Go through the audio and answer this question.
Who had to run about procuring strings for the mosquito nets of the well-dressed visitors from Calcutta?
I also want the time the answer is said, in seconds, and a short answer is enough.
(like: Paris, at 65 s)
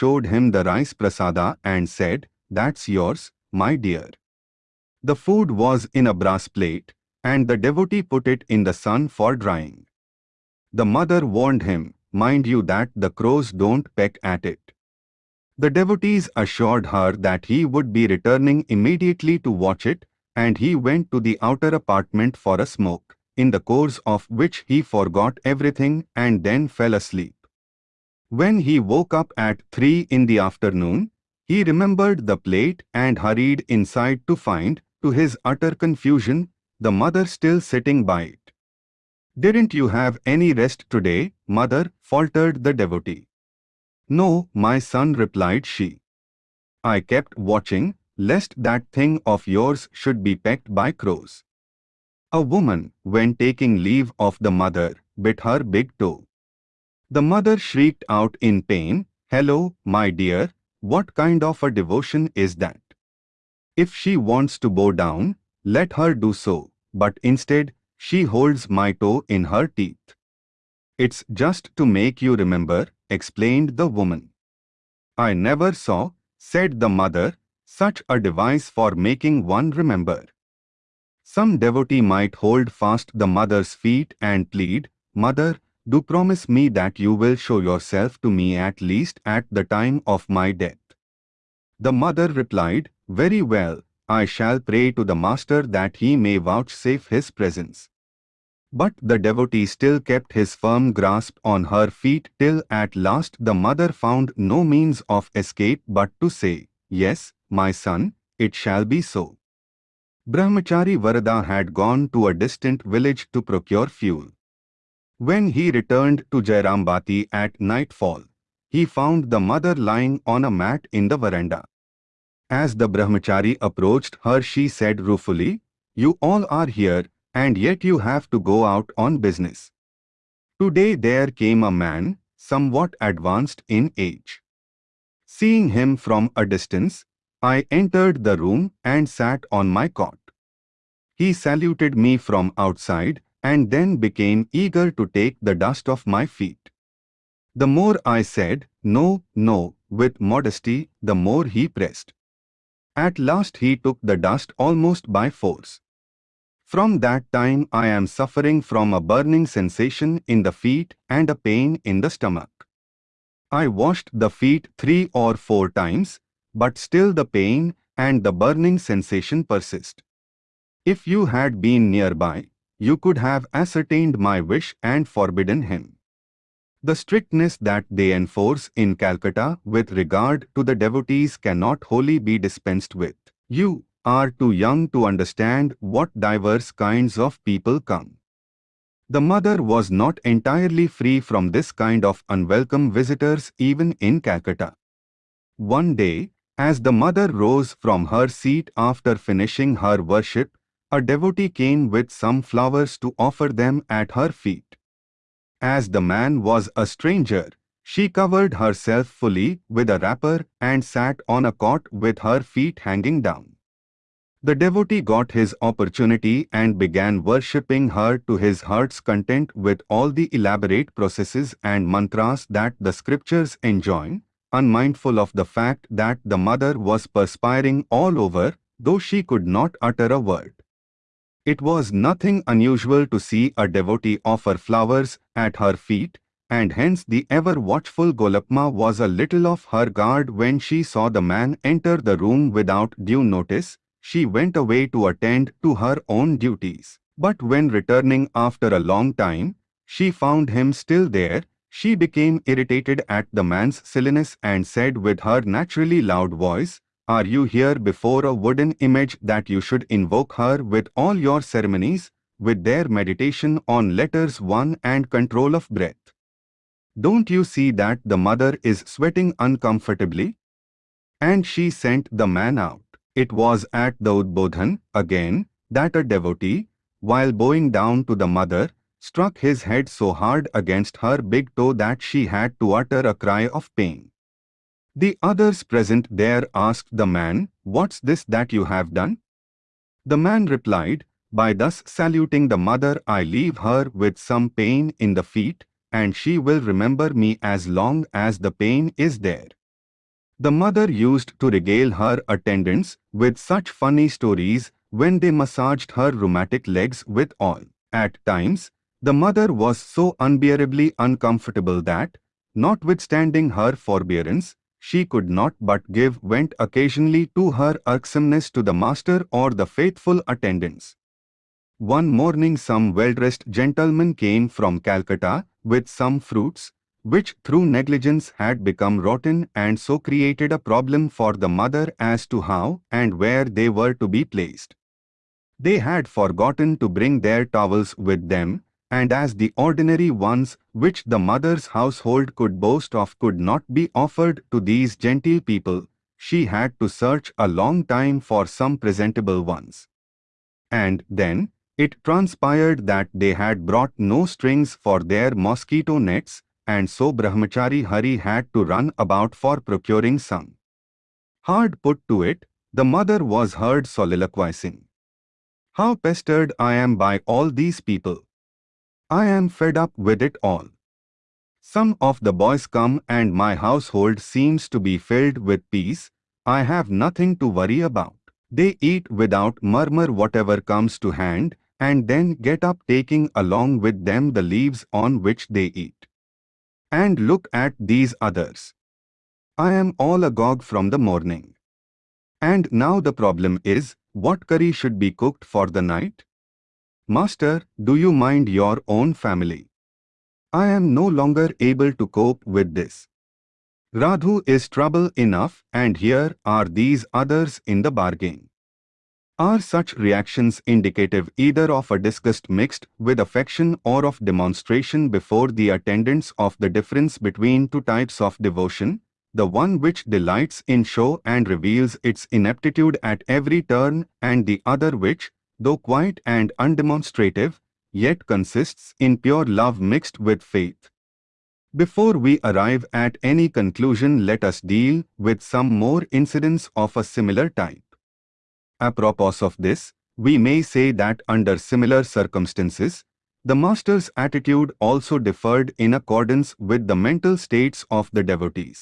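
Brahmachari Hari, at 357 s.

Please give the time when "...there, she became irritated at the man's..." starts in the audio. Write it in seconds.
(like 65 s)
251 s.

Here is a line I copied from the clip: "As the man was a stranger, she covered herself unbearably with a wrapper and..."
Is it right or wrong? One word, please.
wrong.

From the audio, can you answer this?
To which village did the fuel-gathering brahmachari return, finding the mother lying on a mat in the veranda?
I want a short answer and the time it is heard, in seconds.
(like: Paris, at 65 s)
Jairambati, at 116 s.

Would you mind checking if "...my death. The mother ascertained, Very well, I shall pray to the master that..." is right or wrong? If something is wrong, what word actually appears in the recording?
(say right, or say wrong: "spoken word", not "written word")
wrong: "replied", not "ascertained".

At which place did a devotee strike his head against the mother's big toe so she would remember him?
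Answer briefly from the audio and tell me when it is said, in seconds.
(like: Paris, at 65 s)
Udbodhan, at 274 s.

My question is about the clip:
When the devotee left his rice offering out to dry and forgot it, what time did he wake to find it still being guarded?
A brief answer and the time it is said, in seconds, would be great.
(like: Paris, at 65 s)
3 in the afternoon, at 29 s.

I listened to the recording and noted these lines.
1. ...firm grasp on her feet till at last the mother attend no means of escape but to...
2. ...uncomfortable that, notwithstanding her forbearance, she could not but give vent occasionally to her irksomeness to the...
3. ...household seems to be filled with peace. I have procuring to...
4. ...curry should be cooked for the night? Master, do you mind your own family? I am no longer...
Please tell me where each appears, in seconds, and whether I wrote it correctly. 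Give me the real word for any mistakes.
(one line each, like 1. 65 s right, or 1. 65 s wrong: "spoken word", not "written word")
1. 100 s wrong: "found", not "attend"
2. 310 s right
3. 373 s wrong: "nothing", not "procuring"
4. 394 s right.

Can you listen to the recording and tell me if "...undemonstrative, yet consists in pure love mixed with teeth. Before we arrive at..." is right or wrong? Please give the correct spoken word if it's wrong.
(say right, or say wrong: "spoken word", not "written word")
wrong: "faith", not "teeth".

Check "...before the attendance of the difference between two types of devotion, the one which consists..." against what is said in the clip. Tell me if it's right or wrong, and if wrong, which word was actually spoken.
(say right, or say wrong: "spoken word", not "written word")
wrong: "delights", not "consists".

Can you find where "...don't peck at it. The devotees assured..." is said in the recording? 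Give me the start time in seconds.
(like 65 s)
13 s.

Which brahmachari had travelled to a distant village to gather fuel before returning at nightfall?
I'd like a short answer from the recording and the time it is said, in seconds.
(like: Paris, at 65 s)
Varada, at 110 s.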